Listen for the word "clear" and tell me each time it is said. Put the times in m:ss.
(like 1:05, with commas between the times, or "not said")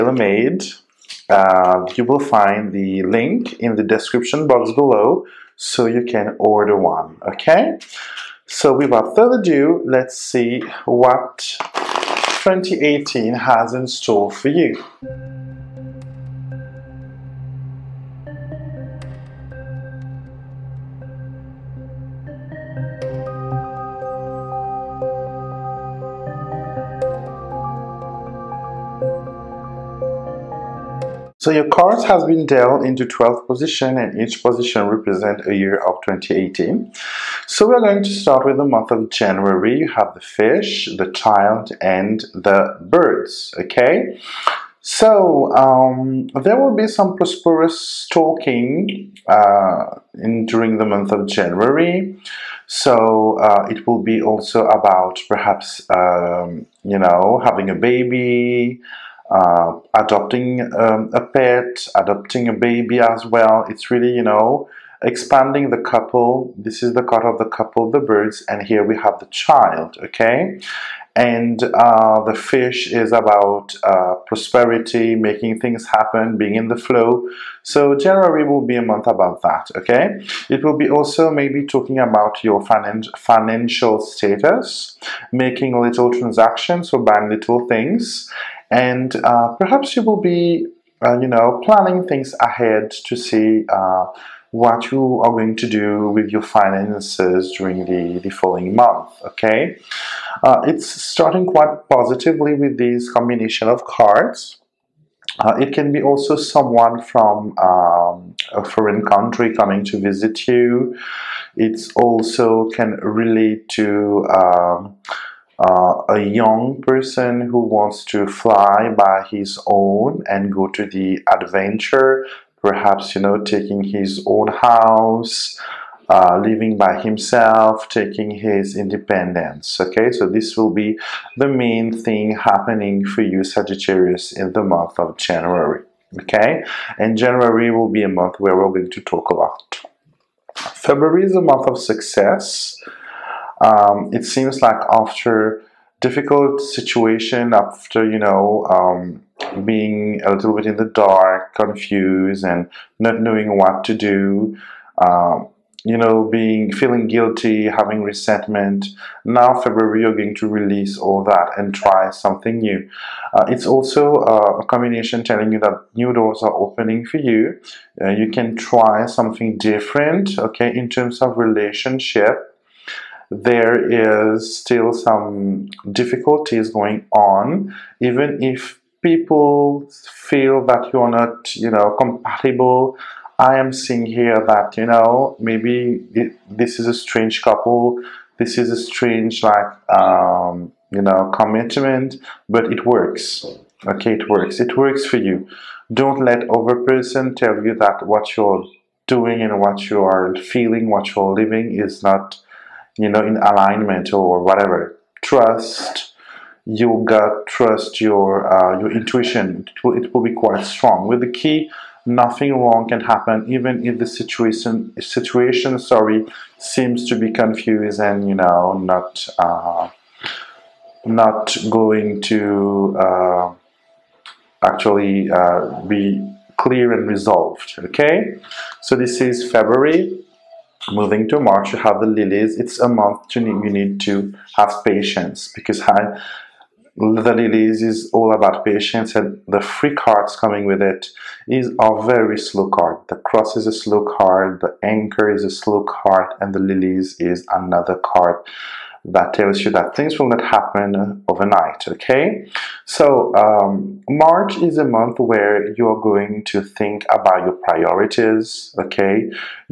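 3:46.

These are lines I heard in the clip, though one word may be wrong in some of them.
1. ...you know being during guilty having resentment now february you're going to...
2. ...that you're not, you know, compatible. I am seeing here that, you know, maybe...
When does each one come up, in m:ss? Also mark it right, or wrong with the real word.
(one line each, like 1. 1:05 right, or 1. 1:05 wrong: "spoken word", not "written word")
1. 2:35 wrong: "feeling", not "during"
2. 3:00 right.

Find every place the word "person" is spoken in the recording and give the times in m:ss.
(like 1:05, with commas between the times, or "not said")
1:56, 3:16.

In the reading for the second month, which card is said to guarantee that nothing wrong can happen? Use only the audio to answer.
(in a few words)
the key.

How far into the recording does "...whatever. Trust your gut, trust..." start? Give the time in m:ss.
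3:24.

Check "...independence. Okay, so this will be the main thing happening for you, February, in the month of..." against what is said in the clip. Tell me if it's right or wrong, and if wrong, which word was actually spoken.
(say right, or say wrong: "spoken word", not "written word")
wrong: "Sagittarius", not "February".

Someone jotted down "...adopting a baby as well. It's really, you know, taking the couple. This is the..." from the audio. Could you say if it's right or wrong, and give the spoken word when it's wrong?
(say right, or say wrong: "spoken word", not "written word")
wrong: "expanding", not "taking".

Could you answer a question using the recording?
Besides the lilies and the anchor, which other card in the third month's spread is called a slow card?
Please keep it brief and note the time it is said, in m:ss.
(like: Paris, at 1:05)
the cross, at 4:03.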